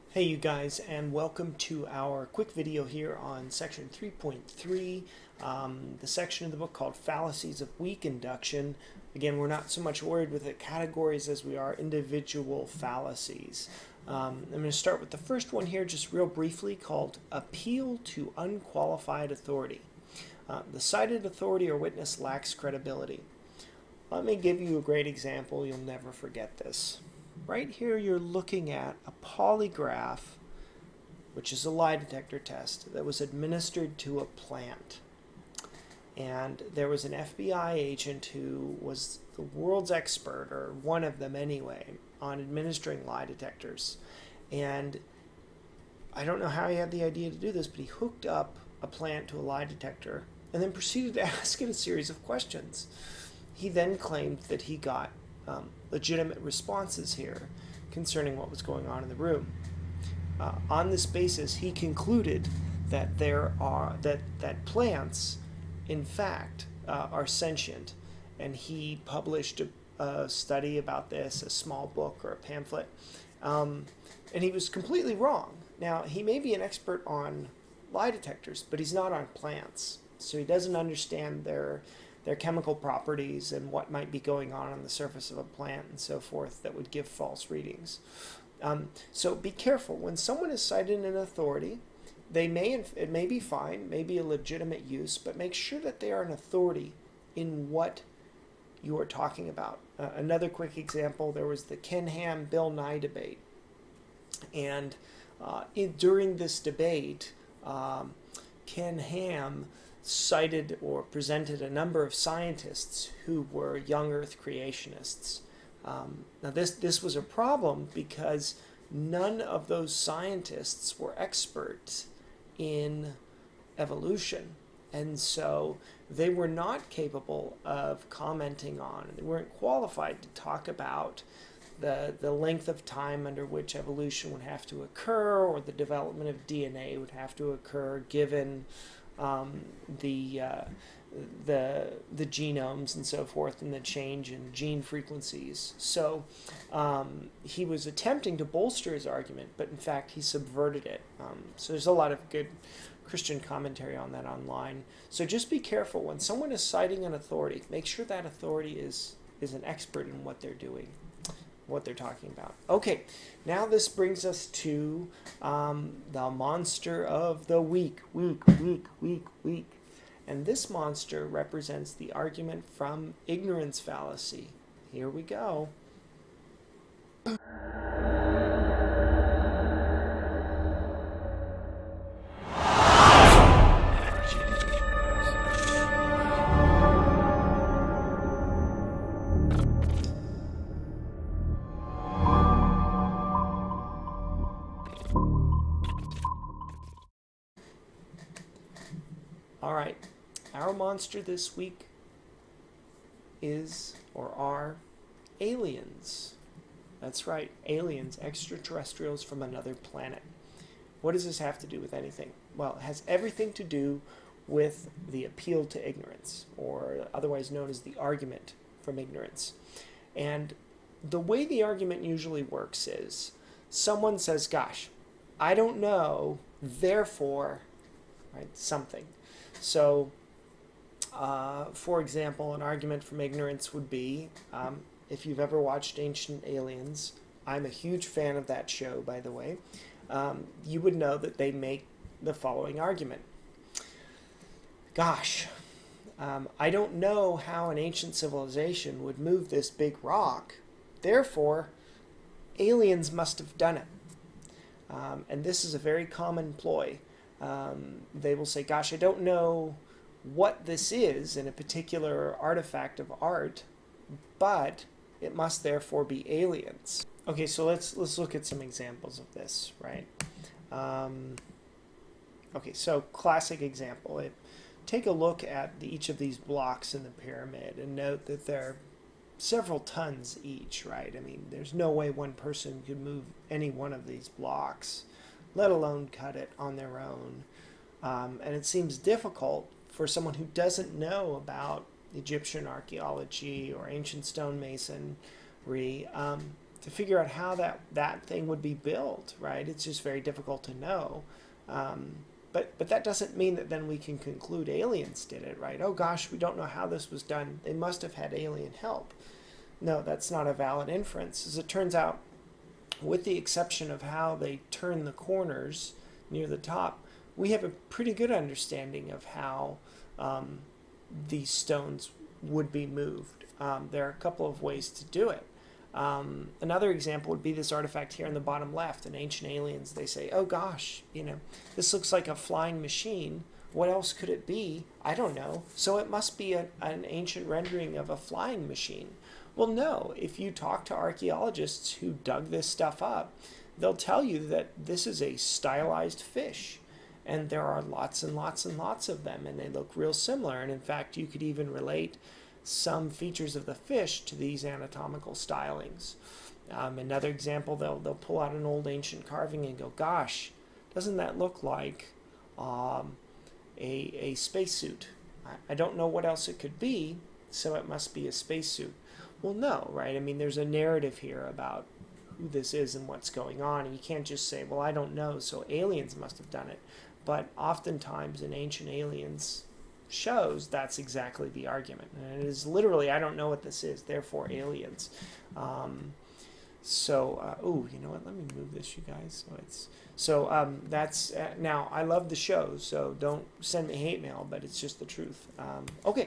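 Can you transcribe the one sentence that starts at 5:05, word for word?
Oh gosh, we don't know how this was done.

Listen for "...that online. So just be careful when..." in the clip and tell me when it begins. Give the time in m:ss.
2:34.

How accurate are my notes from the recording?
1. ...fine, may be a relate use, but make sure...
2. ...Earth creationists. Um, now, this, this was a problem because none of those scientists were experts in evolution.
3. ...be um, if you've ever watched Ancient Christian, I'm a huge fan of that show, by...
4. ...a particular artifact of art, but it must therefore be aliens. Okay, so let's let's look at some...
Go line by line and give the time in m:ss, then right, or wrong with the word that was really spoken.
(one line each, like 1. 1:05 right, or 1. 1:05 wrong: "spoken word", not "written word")
1. 1:33 wrong: "legitimate", not "relate"
2. 1:54 right
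3. 3:53 wrong: "Aliens", not "Christian"
4. 4:21 right.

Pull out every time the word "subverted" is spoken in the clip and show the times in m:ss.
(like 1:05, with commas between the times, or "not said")
2:30.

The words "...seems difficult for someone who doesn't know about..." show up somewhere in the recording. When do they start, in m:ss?
4:48.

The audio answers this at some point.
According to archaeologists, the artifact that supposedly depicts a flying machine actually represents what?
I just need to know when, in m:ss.
5:45.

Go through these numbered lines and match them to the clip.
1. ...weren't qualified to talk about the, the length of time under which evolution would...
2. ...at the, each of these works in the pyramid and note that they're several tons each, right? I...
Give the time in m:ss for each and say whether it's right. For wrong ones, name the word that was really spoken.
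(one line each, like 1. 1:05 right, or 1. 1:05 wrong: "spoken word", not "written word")
1. 2:09 right
2. 4:35 wrong: "blocks", not "works".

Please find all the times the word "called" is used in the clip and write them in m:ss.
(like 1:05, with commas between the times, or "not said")
0:06, 0:16.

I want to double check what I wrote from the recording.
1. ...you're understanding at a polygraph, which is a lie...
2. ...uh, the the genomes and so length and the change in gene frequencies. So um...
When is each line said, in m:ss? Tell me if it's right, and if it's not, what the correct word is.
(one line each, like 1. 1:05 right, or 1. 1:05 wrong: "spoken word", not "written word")
1. 0:27 wrong: "looking", not "understanding"
2. 2:20 wrong: "forth", not "length".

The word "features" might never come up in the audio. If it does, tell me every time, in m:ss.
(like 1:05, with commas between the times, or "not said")
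5:53.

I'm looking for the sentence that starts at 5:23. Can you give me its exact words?
Um, there are a couple of ways to do it.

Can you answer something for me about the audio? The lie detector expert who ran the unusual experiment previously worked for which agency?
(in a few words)
FBI.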